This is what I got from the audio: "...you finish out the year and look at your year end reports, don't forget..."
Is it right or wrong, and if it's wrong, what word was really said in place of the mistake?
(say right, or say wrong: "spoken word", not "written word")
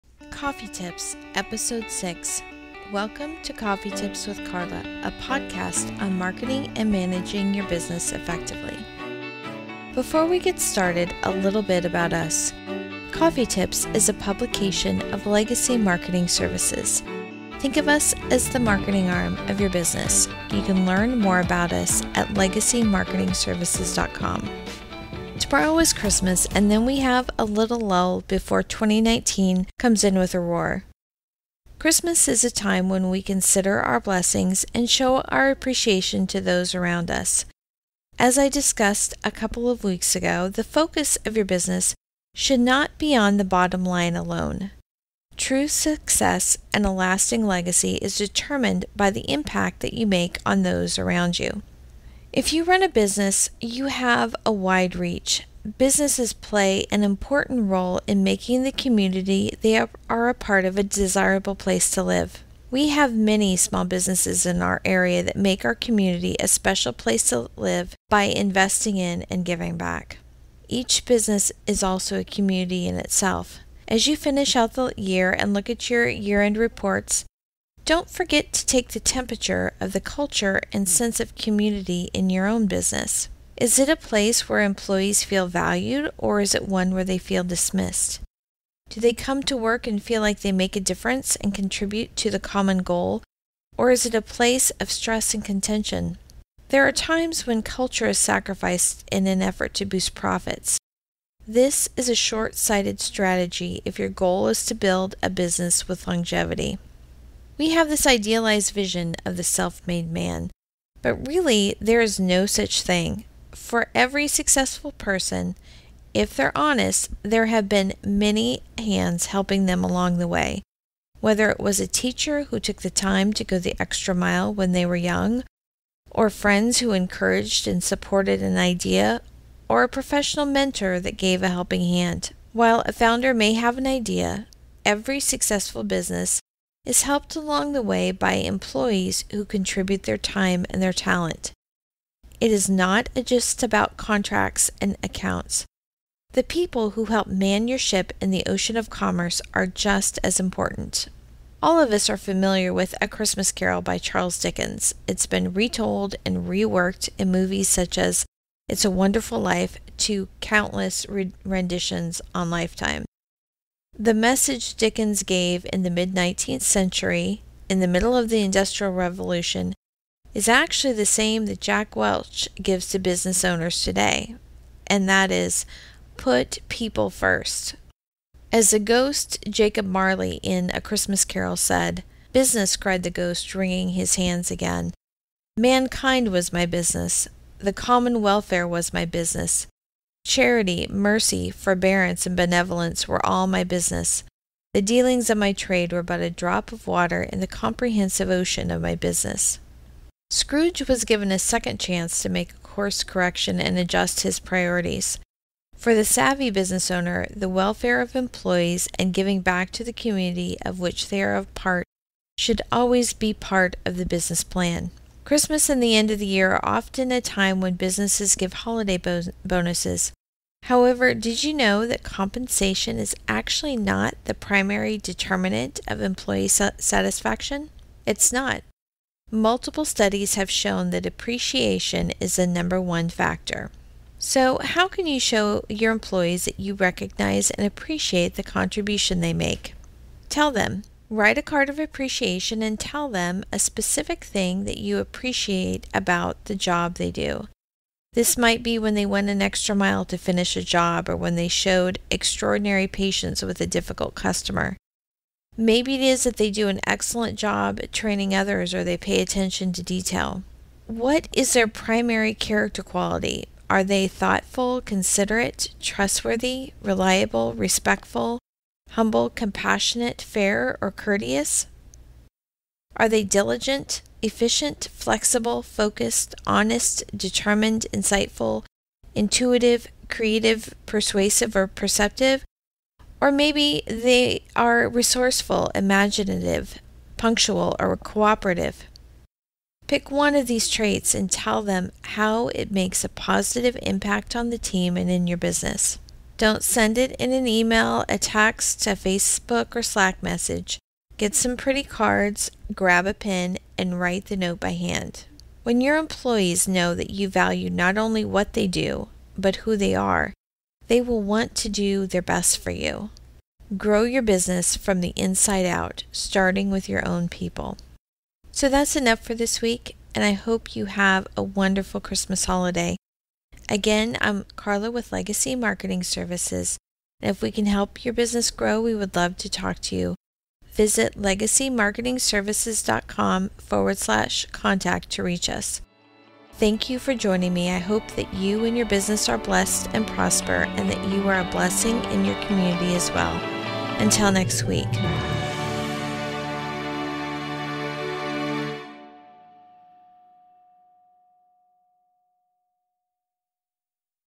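right.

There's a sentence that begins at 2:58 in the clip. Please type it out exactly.
As the ghost Jacob Marley in A Christmas Carol said, Business, cried the ghost, wringing his hands again.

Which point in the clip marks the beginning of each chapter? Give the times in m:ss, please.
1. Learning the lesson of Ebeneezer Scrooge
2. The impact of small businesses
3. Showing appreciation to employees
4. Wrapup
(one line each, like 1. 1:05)
1. 2:30
2. 0:30
3. 3:29
4. 5:21.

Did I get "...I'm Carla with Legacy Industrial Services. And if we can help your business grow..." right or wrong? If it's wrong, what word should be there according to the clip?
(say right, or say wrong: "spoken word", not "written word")
wrong: "Marketing", not "Industrial".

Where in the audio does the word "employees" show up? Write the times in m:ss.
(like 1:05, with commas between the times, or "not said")
1:24, 2:18, 3:28, 3:46, 3:55, 5:05.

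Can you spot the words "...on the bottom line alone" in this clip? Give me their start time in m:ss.
0:43.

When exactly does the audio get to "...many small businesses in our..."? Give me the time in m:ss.
1:03.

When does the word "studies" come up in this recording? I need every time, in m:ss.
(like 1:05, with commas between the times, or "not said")
3:49.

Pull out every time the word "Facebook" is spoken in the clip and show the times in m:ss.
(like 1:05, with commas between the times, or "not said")
4:58.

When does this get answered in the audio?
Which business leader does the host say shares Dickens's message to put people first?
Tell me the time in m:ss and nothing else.
2:51.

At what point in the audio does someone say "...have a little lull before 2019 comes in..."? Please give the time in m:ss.
0:26.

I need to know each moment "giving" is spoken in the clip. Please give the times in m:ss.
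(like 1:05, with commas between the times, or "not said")
1:09, 3:29.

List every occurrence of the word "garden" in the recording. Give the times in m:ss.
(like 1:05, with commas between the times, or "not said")
not said.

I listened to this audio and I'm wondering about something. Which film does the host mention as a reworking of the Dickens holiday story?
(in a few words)
It's a Wonderful Life.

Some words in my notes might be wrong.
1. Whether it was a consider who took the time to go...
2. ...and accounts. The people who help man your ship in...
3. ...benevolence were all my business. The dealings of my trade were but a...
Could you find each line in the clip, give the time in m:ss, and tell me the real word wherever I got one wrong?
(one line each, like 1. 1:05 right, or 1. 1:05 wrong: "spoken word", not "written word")
1. 2:01 wrong: "teacher", not "consider"
2. 2:24 right
3. 3:12 right.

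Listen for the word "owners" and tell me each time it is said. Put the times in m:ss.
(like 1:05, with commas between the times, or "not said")
2:53, 3:26.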